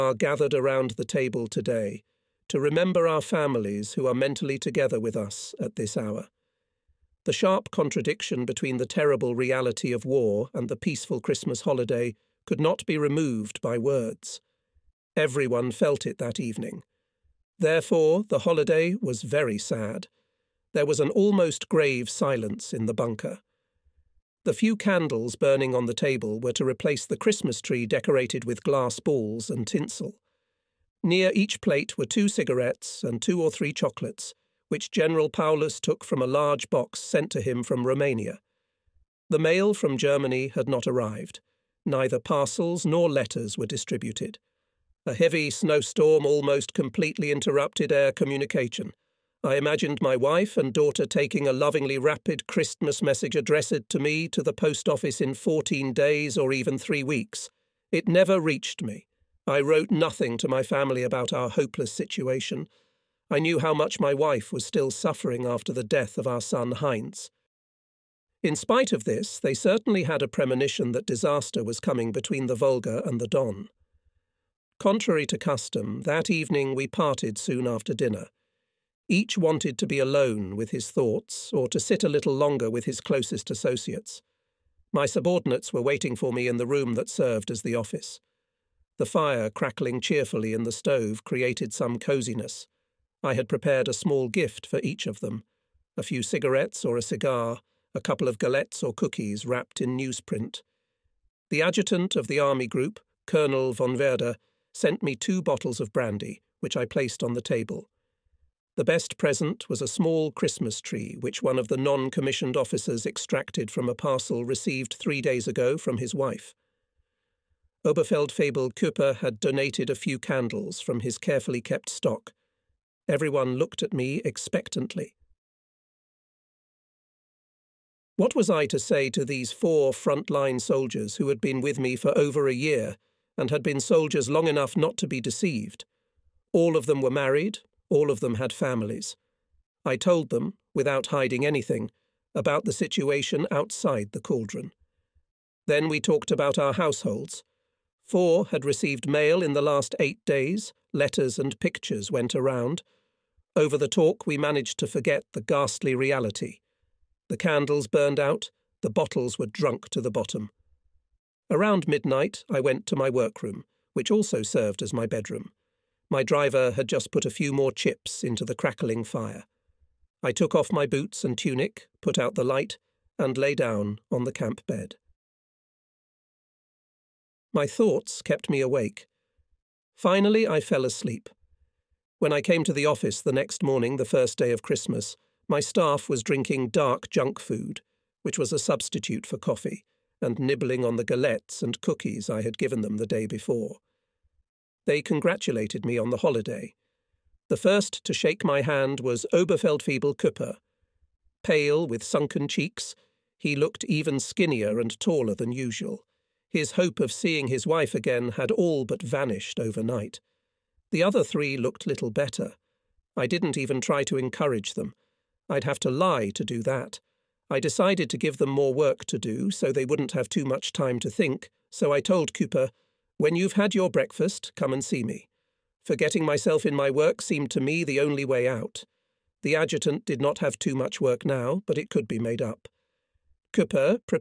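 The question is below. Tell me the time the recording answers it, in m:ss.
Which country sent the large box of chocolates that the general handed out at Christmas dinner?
0:37.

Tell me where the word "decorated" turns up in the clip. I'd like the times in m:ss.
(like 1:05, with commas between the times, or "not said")
0:27.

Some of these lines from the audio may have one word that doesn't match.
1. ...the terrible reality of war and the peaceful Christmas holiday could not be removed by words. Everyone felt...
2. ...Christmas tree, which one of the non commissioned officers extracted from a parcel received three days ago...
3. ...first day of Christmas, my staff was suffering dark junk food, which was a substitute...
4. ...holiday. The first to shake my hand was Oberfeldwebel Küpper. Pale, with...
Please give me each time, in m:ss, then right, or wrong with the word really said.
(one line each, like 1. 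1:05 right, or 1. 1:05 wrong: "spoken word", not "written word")
1. 0:08 right
2. 1:50 right
3. 3:04 wrong: "drinking", not "suffering"
4. 3:16 right.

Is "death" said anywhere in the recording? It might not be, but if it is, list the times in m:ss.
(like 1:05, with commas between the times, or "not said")
1:05.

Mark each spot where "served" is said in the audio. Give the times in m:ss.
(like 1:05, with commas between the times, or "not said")
1:27, 2:44.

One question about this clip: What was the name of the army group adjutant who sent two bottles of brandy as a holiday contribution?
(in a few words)
Colonel von Werder.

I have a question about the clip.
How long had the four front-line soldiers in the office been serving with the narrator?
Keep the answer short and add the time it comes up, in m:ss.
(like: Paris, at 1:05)
over a year, at 2:12.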